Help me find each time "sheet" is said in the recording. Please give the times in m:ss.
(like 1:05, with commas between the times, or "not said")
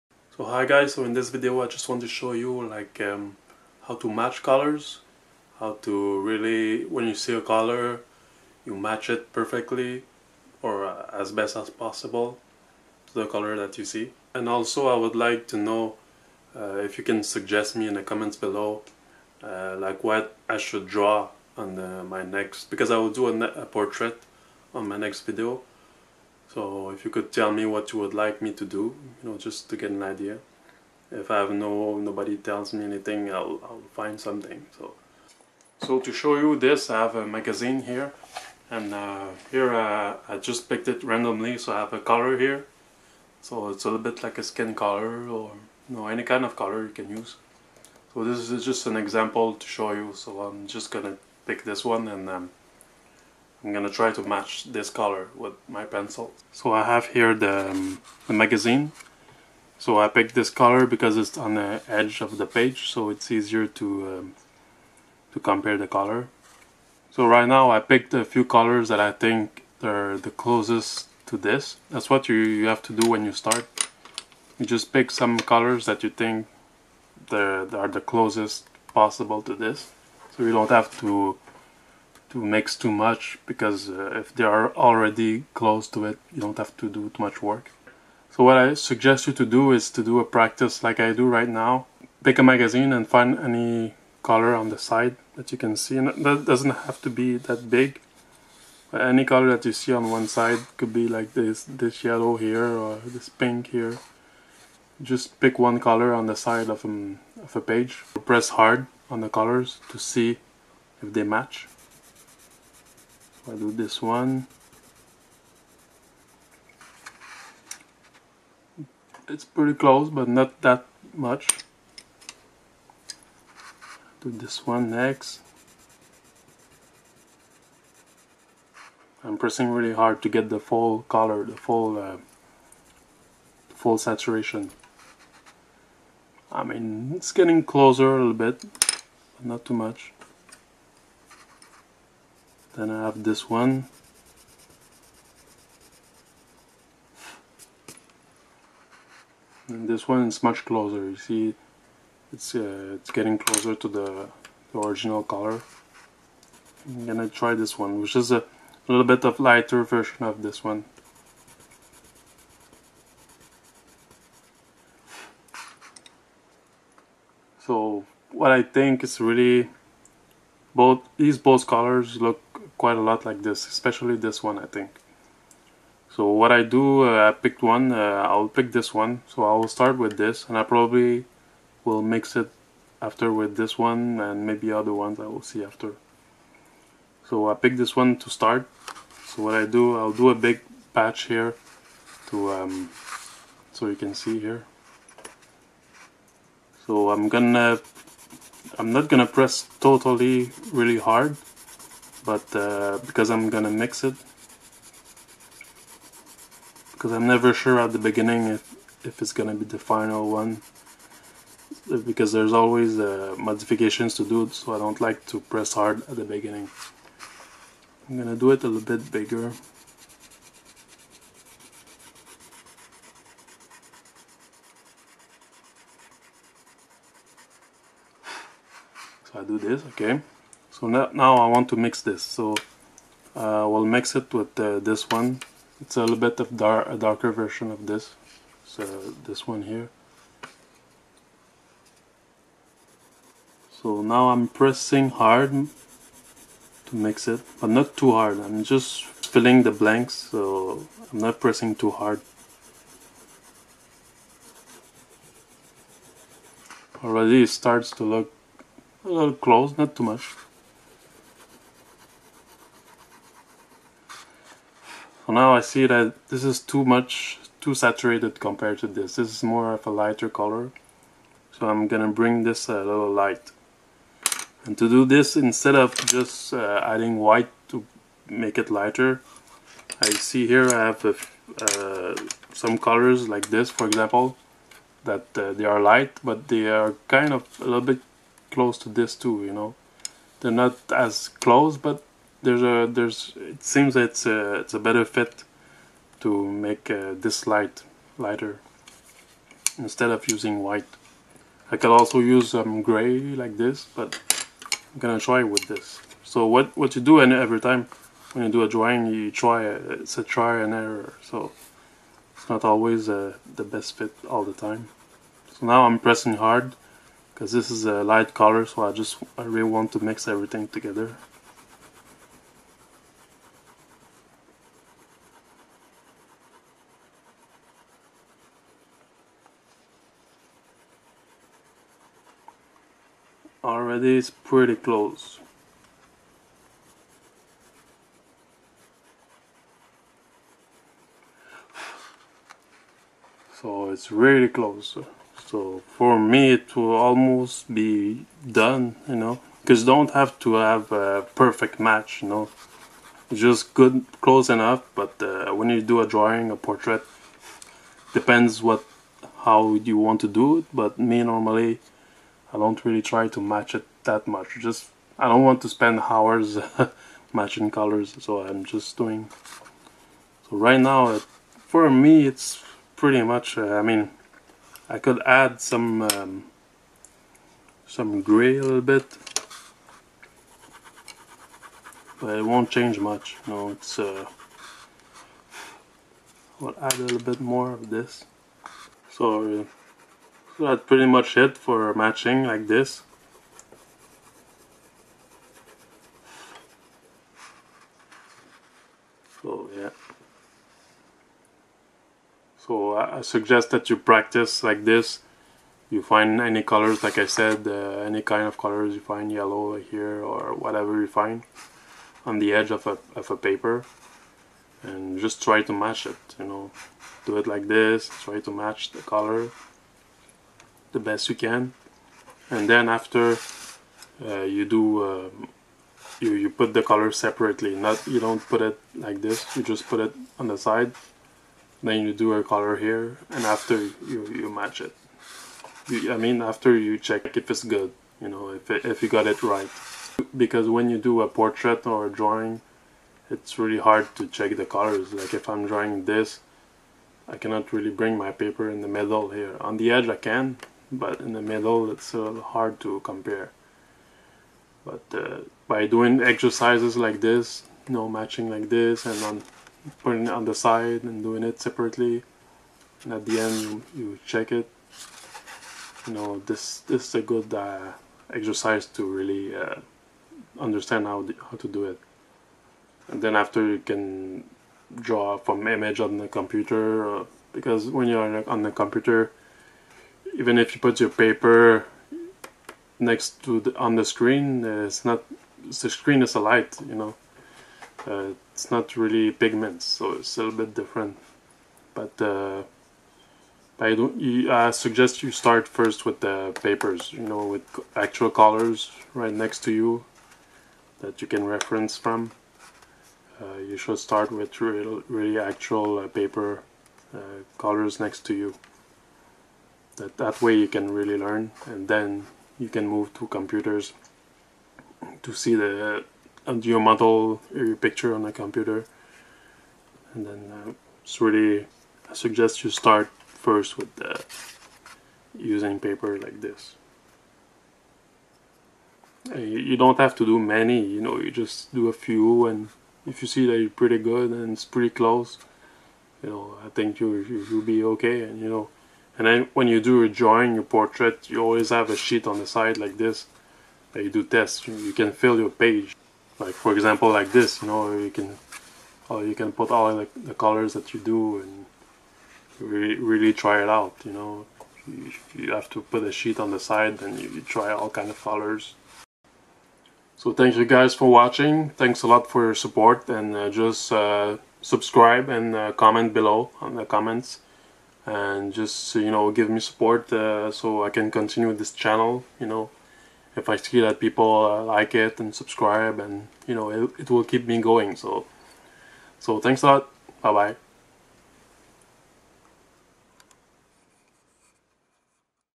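9:01, 9:16.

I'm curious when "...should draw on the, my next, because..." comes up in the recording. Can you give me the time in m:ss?
0:20.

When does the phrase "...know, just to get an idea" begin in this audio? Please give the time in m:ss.
0:29.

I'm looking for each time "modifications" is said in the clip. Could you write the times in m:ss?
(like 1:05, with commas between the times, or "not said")
3:33.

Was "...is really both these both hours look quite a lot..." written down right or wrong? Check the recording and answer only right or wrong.
wrong.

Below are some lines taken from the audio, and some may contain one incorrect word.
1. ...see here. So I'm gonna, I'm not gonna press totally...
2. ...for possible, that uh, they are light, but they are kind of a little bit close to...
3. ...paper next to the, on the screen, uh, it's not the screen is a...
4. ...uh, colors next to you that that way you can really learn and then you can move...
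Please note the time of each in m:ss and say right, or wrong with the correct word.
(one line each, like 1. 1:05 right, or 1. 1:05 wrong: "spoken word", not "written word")
1. 3:14 right
2. 4:43 wrong: "example", not "possible"
3. 8:01 right
4. 8:27 right.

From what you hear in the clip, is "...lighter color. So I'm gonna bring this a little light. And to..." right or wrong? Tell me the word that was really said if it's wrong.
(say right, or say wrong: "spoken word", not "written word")
right.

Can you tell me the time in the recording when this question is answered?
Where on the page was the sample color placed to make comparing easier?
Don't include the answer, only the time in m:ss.
1:01.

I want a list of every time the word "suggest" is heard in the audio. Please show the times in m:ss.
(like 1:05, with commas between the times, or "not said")
0:17, 1:28, 6:43, 8:14, 8:42.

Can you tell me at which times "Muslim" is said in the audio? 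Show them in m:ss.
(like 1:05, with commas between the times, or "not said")
not said.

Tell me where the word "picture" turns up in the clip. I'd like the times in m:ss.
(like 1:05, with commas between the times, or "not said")
8:37.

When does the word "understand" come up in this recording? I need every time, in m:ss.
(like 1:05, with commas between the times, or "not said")
7:50.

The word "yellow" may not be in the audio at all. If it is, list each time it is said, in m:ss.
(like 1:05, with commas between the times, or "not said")
1:42, 6:49.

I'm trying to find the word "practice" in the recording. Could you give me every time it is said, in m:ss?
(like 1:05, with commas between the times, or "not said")
1:30, 6:43.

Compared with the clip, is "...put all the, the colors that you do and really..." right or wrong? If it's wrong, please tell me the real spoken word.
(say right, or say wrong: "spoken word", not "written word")
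right.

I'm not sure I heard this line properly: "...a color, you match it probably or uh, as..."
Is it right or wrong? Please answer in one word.
wrong.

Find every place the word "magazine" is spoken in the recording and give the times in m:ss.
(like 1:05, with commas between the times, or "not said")
0:37, 0:58, 1:32.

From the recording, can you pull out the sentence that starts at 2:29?
And this one is much closer, you see it's uh, it's getting closer to the, the, original color.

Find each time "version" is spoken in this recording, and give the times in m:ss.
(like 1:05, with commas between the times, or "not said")
2:39, 3:57.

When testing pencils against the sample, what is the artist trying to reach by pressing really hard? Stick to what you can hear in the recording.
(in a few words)
Full saturation.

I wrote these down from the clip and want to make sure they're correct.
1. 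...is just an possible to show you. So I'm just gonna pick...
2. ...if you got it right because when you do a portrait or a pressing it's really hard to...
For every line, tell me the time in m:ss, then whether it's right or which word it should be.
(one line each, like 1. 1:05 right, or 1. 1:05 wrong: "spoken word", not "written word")
1. 0:48 wrong: "example", not "possible"
2. 7:18 wrong: "drawing", not "pressing".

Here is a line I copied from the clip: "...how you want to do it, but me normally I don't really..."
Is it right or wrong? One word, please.
right.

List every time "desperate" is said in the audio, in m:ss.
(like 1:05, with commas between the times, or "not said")
not said.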